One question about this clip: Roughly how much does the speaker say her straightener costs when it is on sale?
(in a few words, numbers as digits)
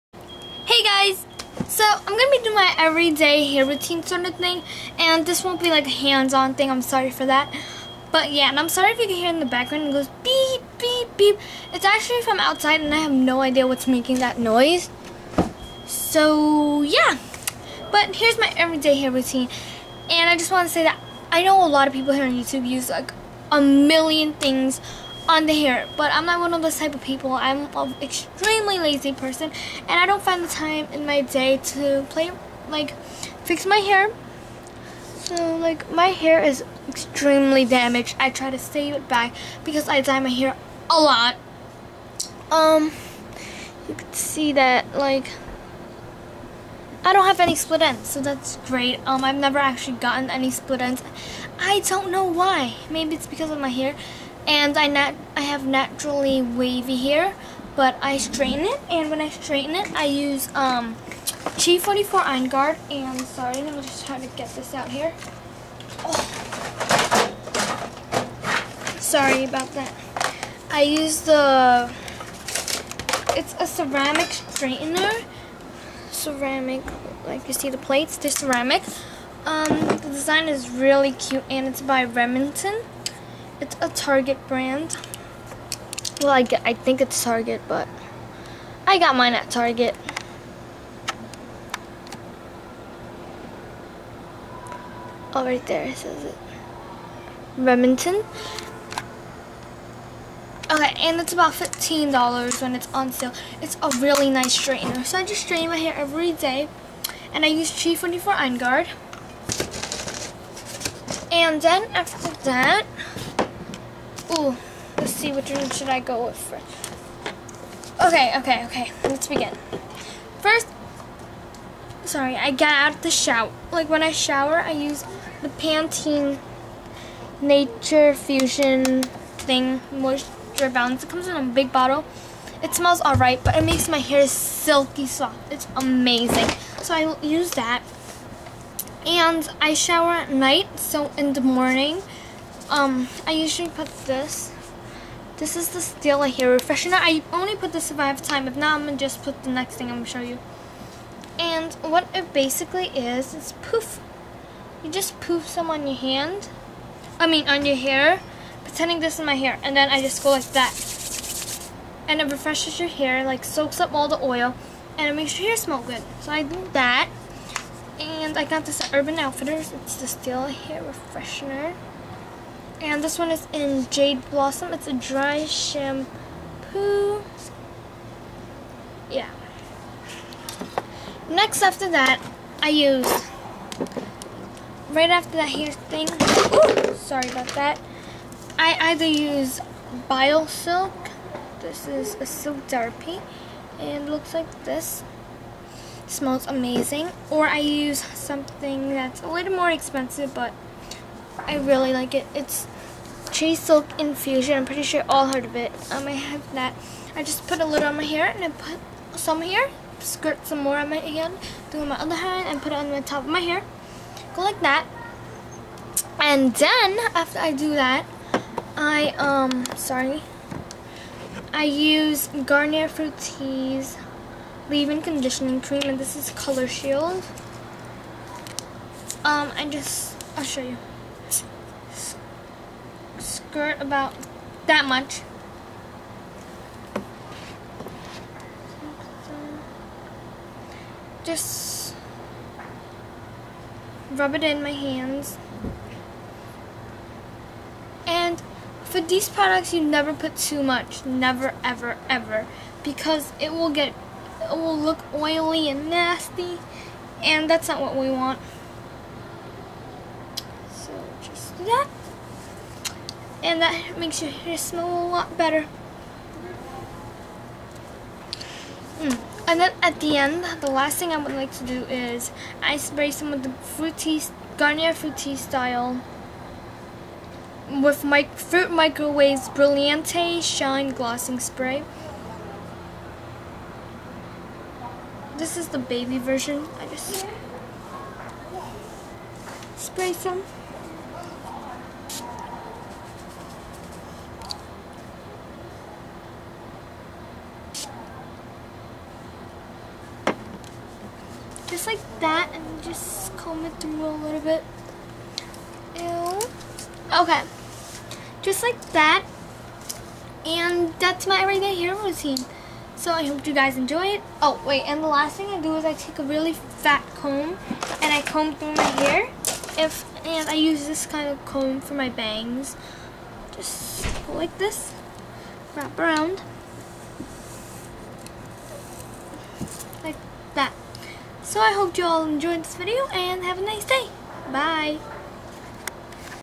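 $15.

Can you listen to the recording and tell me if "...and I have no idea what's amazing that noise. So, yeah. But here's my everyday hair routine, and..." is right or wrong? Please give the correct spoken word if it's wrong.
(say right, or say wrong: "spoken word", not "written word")
wrong: "making", not "amazing".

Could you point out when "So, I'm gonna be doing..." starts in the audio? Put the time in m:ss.
0:01.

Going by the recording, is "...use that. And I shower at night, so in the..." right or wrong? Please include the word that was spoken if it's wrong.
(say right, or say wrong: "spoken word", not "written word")
right.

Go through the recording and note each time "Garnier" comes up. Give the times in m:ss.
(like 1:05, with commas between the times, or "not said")
3:42, 4:34.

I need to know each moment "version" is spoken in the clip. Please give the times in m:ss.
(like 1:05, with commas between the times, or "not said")
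4:46.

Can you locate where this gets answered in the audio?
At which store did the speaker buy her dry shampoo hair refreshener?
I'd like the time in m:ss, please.
2:48.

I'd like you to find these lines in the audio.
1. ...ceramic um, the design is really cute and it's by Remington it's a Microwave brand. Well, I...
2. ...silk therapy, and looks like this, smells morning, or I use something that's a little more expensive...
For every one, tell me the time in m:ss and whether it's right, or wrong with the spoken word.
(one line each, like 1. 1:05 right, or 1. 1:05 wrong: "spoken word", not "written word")
1. 1:18 wrong: "Target", not "Microwave"
2. 3:12 wrong: "amazing", not "morning".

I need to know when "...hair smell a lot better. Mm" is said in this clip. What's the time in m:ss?
4:24.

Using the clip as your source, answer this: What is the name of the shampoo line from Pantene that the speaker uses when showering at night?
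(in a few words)
Natural Fusion.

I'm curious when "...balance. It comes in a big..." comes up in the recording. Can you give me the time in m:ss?
2:10.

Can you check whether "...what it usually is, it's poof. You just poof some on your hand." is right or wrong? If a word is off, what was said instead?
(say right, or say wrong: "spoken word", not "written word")
wrong: "basically", not "usually".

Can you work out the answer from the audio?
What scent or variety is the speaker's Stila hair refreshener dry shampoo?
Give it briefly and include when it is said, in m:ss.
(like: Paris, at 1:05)
Jade Blossom, at 2:53.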